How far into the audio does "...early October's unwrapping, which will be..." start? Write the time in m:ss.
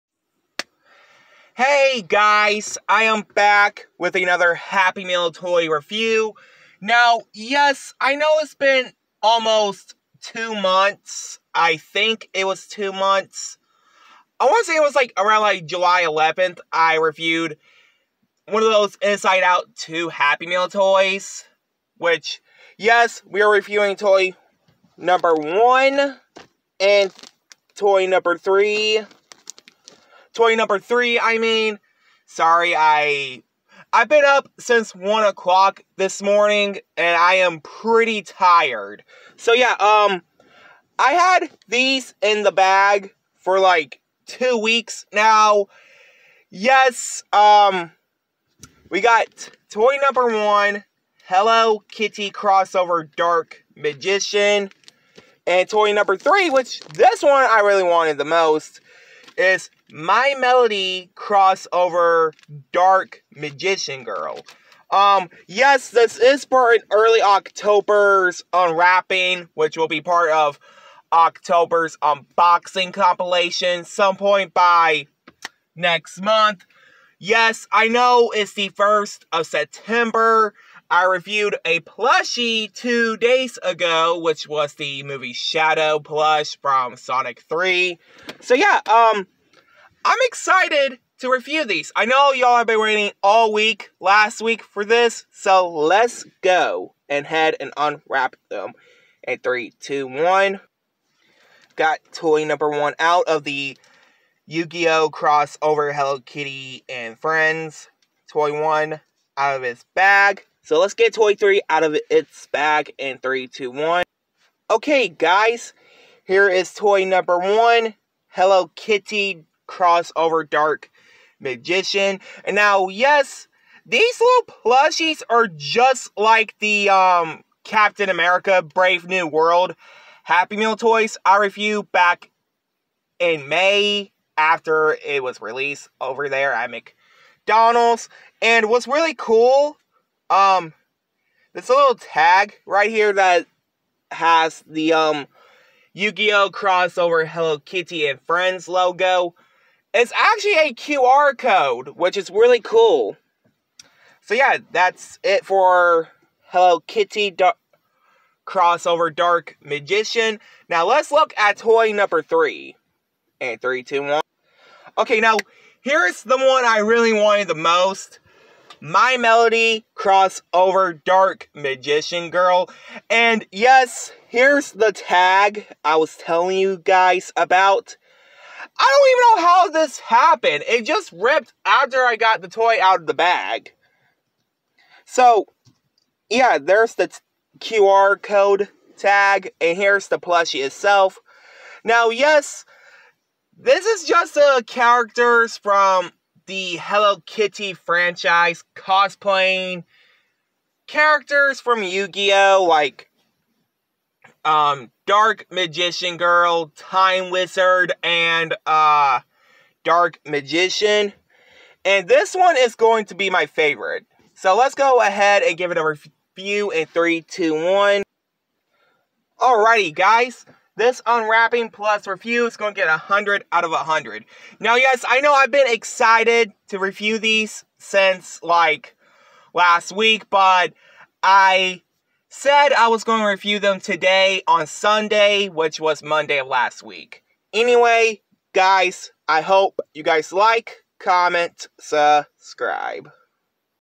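1:06.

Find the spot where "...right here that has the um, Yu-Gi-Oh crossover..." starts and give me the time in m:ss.
2:22.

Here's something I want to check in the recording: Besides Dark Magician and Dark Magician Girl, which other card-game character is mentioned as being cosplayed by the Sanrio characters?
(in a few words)
Time Wizard.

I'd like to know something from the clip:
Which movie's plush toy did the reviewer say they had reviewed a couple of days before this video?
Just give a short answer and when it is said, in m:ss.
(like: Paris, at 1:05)
Sonic 3, at 1:26.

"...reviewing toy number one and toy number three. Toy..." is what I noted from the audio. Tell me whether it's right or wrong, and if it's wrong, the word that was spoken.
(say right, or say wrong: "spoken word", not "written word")
right.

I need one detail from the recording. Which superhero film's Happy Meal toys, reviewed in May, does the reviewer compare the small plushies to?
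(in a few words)
Captain America Brave New World.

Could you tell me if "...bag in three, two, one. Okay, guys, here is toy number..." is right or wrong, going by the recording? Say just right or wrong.
right.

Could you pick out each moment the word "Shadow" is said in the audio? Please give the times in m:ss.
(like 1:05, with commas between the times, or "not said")
1:25.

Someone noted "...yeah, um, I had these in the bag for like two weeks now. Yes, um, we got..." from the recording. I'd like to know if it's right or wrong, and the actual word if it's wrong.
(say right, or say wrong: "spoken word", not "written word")
right.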